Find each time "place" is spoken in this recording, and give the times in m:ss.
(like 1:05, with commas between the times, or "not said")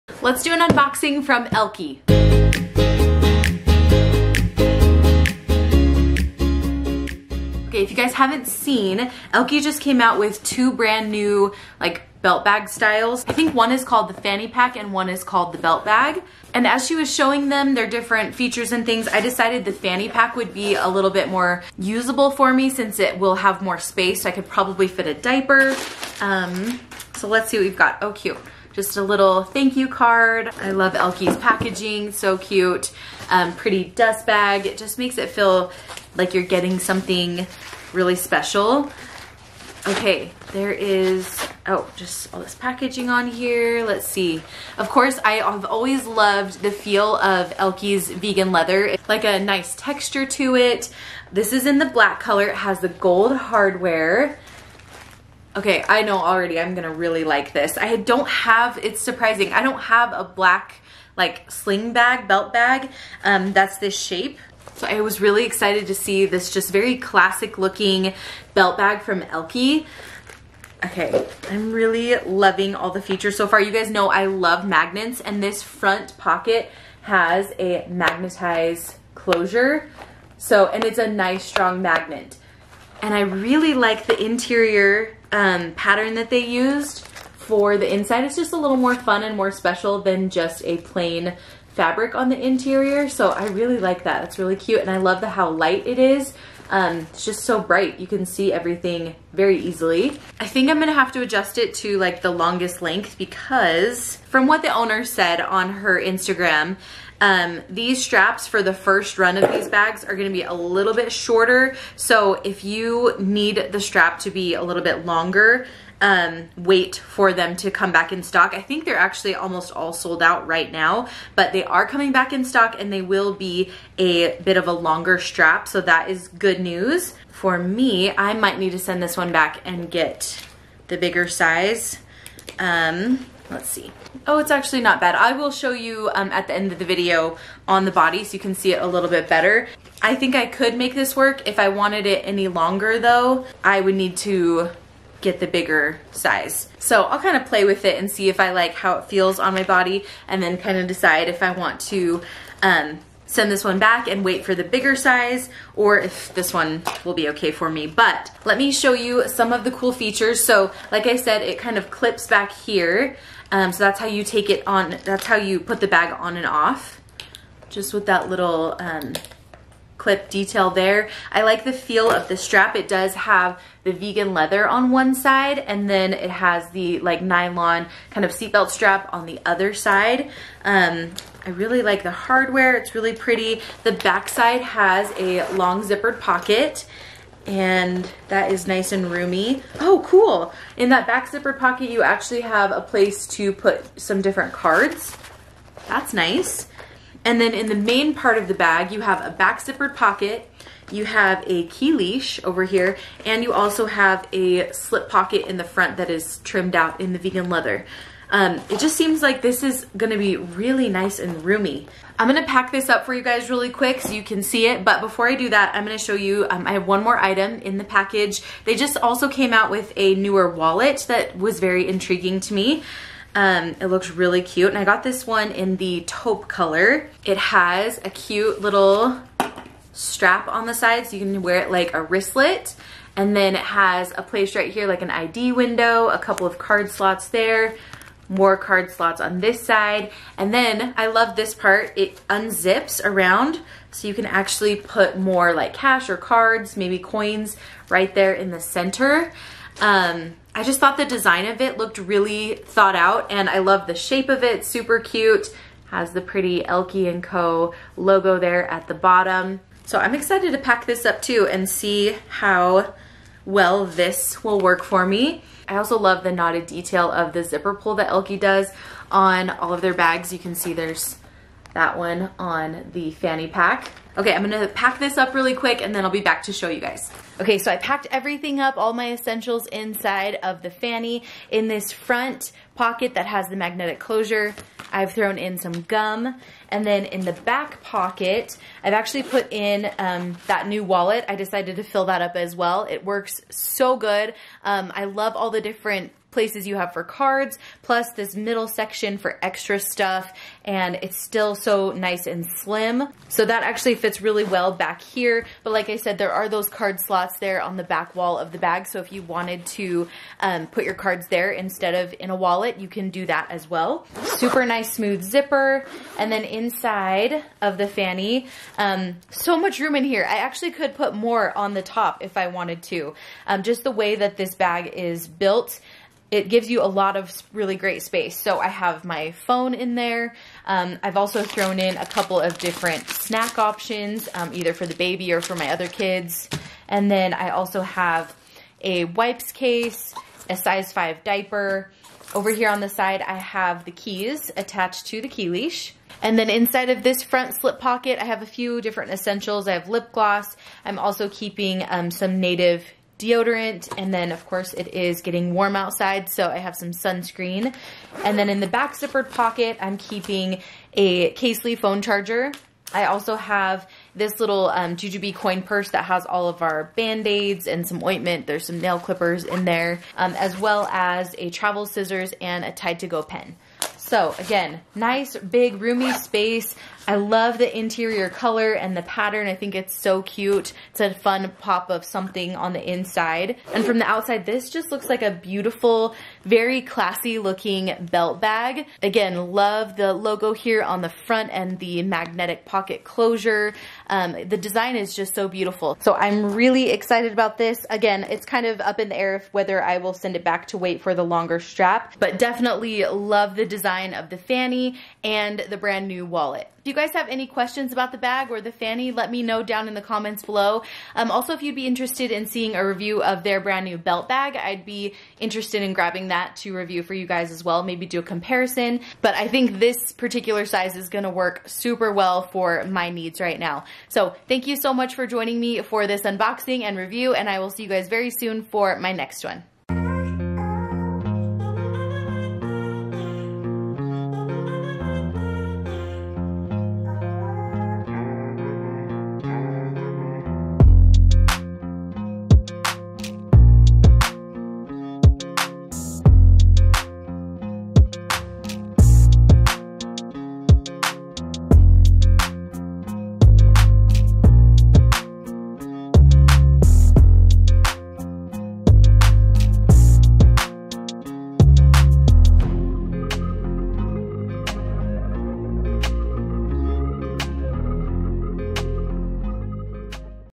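3:12, 3:54, 4:56.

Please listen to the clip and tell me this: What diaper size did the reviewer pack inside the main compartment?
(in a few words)
size 5.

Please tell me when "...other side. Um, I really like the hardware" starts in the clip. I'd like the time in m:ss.
2:59.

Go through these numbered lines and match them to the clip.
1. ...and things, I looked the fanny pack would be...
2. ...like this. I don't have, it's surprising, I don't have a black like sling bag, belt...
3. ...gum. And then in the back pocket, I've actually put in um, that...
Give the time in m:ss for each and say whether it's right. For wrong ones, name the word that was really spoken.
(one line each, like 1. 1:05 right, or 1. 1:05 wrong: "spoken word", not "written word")
1. 0:18 wrong: "decided", not "looked"
2. 0:57 right
3. 4:45 right.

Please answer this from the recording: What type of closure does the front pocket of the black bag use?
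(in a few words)
magnetized closure.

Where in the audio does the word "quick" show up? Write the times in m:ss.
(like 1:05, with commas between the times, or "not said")
3:33, 4:35.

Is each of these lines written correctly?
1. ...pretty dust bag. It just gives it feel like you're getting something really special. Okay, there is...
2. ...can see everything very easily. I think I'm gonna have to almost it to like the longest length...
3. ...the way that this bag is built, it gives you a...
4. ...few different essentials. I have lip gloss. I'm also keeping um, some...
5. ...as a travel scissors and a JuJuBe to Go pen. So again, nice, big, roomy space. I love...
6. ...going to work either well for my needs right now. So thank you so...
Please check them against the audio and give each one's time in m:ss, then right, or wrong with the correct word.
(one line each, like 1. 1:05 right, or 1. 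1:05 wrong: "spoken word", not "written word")
1. 0:33 wrong: "makes", not "gives"
2. 1:38 wrong: "adjust", not "almost"
3. 5:23 right
4. 5:48 right
5. 6:10 wrong: "Tide", not "JuJuBe"
6. 7:01 wrong: "super", not "either".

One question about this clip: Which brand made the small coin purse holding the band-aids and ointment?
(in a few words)
JuJuBe.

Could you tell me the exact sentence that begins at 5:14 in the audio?
Super nice smooth zipper, and then inside of the fanny, um, so much room in here.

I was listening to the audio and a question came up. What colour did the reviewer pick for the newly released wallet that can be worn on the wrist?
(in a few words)
taupe.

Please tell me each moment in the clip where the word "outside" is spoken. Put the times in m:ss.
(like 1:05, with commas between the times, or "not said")
5:55, 6:24.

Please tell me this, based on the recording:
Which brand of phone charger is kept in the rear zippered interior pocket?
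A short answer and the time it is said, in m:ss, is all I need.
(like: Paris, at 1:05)
Casely, at 6:01.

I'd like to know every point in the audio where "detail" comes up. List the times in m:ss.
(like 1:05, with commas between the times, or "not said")
2:50, 4:26.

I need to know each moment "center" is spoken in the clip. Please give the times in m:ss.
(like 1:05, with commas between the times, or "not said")
4:08.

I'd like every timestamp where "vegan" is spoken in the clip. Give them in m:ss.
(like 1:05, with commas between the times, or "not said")
0:48, 2:53, 3:27.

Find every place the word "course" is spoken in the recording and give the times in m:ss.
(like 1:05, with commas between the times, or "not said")
0:44, 5:54.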